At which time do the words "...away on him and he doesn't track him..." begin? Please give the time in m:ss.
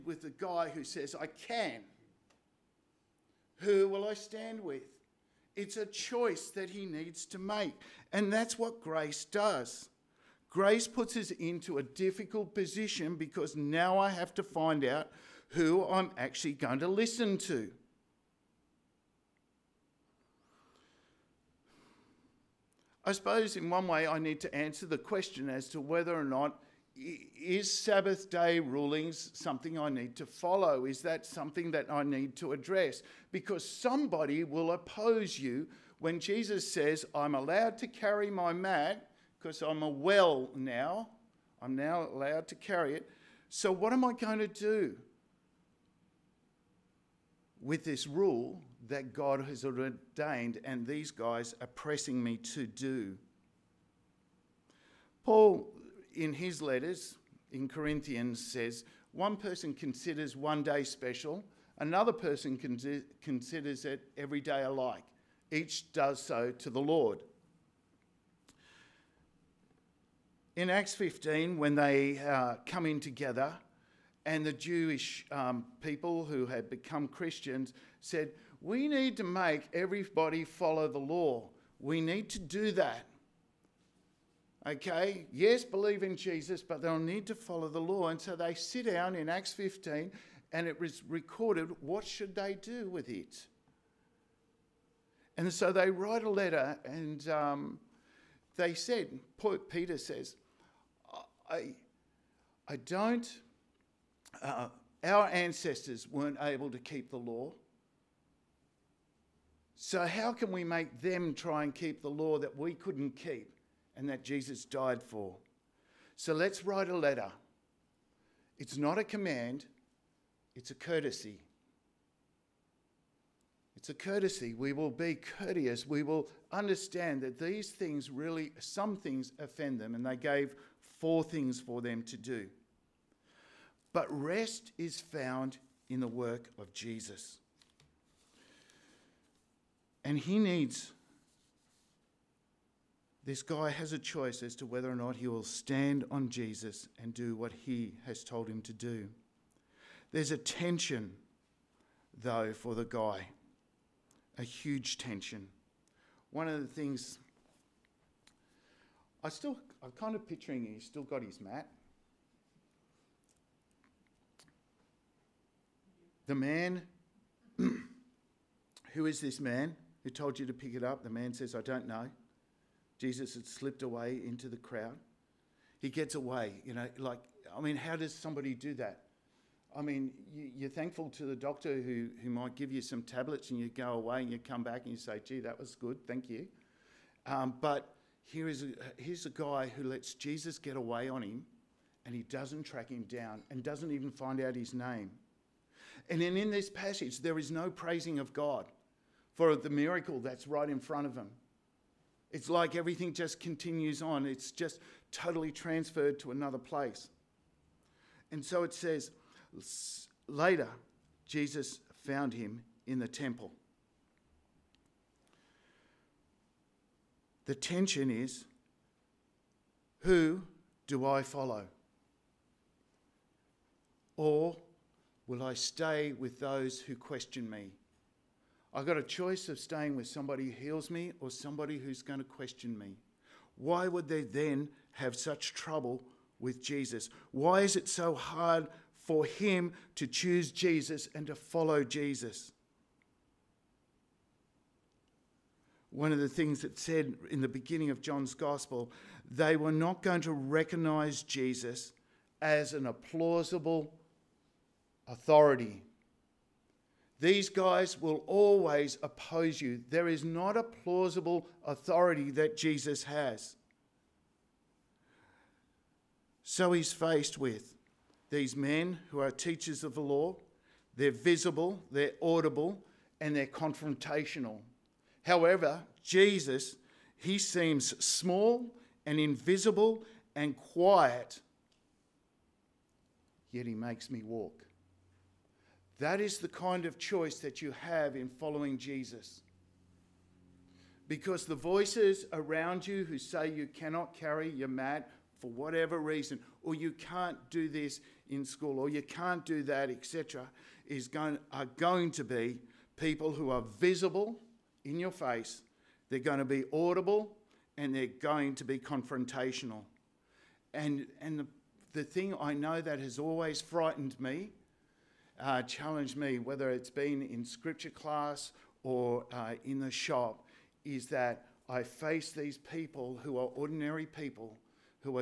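3:10.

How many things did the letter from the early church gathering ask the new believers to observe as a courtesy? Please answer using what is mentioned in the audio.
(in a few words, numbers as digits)
4.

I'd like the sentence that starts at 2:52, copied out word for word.
Jesus had slipped away into the crowd.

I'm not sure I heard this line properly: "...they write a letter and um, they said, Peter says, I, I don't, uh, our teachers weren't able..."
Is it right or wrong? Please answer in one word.
wrong.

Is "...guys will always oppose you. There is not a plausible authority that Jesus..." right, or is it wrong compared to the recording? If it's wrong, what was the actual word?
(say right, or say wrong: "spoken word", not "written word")
right.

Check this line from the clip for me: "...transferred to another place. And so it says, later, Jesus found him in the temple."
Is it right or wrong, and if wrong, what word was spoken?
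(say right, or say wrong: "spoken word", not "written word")
right.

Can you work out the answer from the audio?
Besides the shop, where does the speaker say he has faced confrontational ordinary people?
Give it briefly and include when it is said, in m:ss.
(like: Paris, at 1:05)
scripture class, at 5:17.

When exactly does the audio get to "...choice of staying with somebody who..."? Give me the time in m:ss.
3:49.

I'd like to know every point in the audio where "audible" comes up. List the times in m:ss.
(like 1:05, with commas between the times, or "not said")
4:32, 5:06.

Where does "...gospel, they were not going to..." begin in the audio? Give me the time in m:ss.
4:08.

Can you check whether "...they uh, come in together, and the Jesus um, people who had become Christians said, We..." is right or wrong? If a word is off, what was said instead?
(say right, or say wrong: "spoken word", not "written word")
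wrong: "Jewish", not "Jesus".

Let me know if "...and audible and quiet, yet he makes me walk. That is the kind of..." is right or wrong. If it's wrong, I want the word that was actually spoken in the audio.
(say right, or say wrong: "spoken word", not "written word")
wrong: "invisible", not "audible".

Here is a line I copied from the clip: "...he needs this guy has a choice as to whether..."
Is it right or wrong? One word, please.
right.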